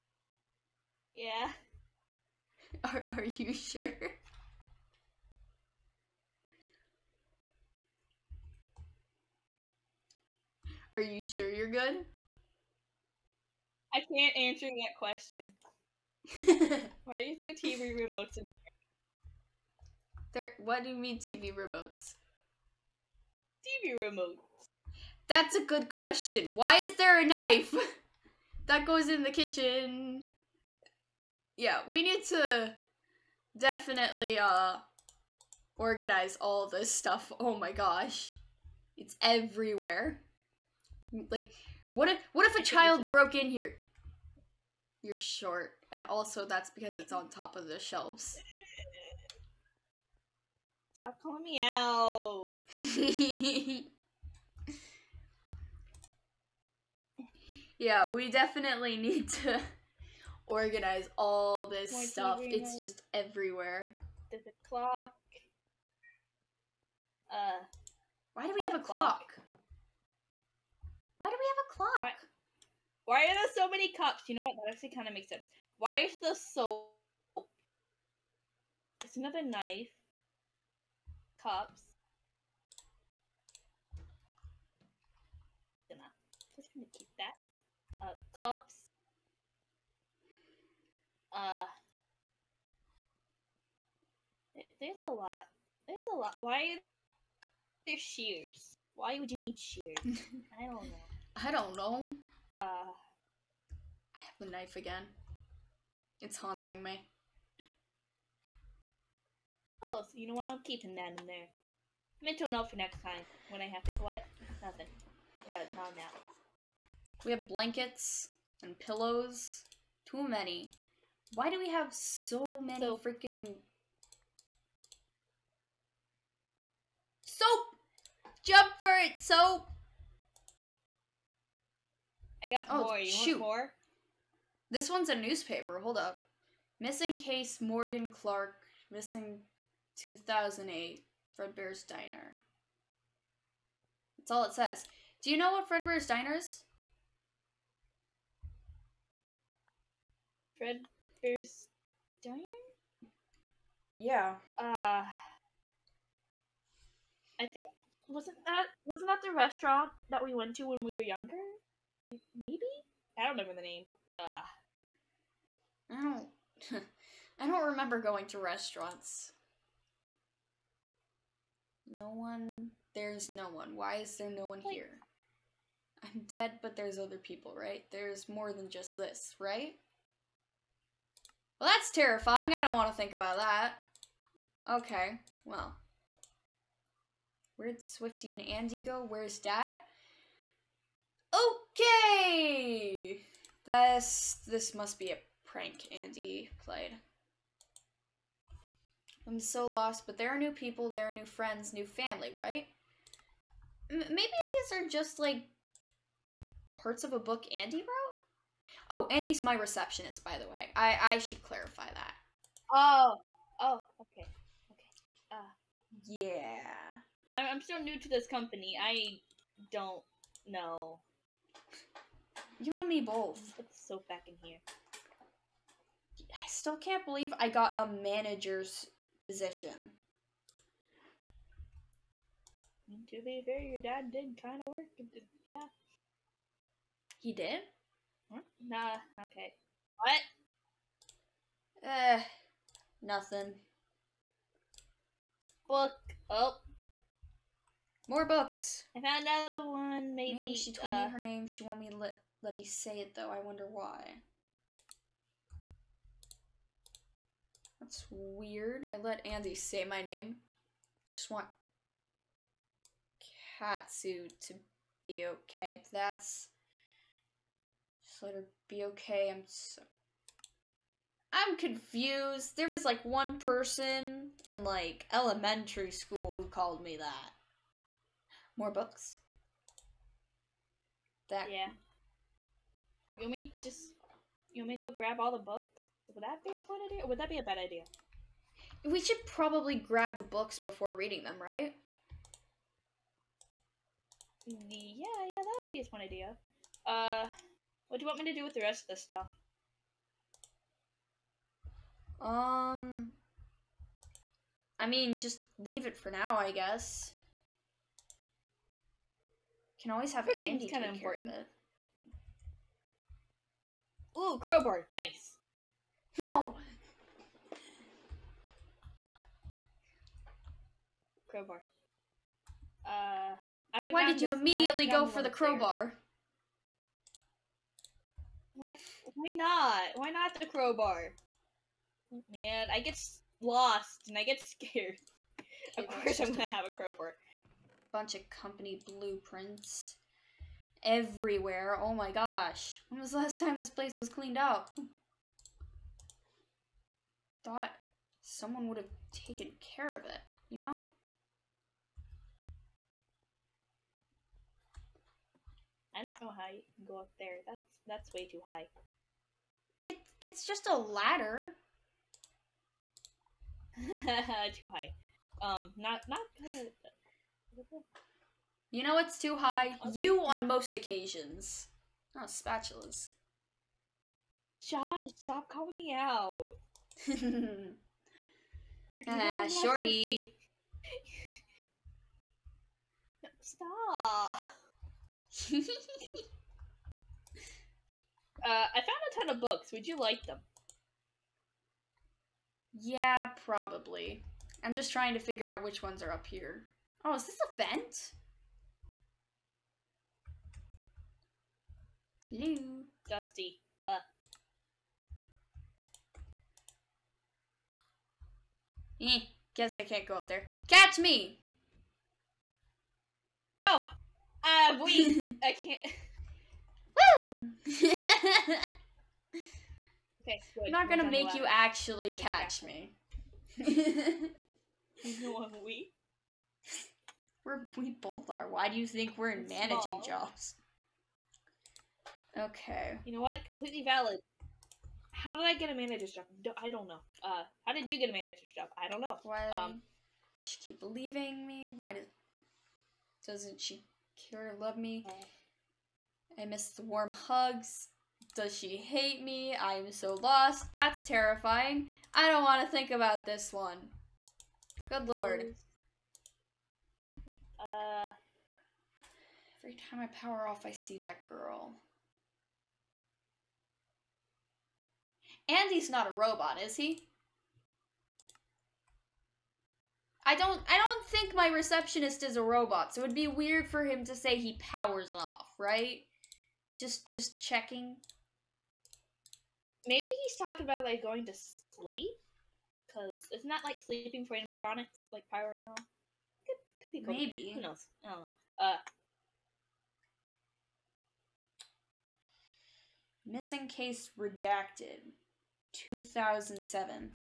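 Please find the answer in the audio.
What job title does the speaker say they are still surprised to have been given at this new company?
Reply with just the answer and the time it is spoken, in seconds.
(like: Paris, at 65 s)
manager, at 228 s.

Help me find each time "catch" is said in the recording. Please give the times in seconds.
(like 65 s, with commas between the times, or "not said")
410 s, 422 s.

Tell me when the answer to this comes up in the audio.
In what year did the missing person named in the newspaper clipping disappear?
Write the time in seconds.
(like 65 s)
139 s.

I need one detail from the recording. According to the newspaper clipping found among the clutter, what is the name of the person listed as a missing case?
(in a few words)
Morgan Clark.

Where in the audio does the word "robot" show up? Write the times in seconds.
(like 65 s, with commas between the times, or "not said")
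466 s, 472 s.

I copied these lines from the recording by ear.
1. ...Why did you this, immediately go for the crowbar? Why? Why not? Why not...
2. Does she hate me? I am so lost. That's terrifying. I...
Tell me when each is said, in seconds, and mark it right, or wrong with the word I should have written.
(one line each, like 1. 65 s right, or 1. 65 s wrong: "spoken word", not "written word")
1. 323 s right
2. 448 s right.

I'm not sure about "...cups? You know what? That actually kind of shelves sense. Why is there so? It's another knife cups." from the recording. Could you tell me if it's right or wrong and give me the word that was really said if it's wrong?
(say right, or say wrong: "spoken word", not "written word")
wrong: "makes", not "shelves".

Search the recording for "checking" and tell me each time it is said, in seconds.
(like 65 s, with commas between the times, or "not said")
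477 s.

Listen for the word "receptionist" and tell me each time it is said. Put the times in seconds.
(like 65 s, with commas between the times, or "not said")
209 s, 471 s.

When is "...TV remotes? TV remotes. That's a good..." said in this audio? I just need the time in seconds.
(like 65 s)
21 s.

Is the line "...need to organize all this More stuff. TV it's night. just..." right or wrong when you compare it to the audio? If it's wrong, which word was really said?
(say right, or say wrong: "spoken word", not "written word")
right.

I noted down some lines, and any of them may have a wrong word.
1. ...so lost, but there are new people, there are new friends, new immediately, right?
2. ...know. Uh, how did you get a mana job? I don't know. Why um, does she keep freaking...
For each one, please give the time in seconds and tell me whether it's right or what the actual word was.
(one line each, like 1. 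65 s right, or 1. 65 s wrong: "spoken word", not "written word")
1. 199 s wrong: "family", not "immediately"
2. 436 s wrong: "leaving", not "freaking".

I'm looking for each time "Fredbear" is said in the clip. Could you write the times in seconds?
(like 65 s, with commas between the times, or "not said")
141 s, 145 s, 150 s.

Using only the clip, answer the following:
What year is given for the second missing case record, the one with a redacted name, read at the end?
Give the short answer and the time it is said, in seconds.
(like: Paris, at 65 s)
2007, at 495 s.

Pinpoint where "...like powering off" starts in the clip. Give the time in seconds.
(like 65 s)
485 s.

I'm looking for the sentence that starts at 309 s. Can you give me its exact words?
Can always have Quick Andy kind of important.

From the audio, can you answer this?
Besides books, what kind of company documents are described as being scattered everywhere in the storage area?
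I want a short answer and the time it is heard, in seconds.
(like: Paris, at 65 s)
blueprints, at 338 s.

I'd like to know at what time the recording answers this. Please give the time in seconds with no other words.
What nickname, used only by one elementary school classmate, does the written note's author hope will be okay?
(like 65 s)
263 s.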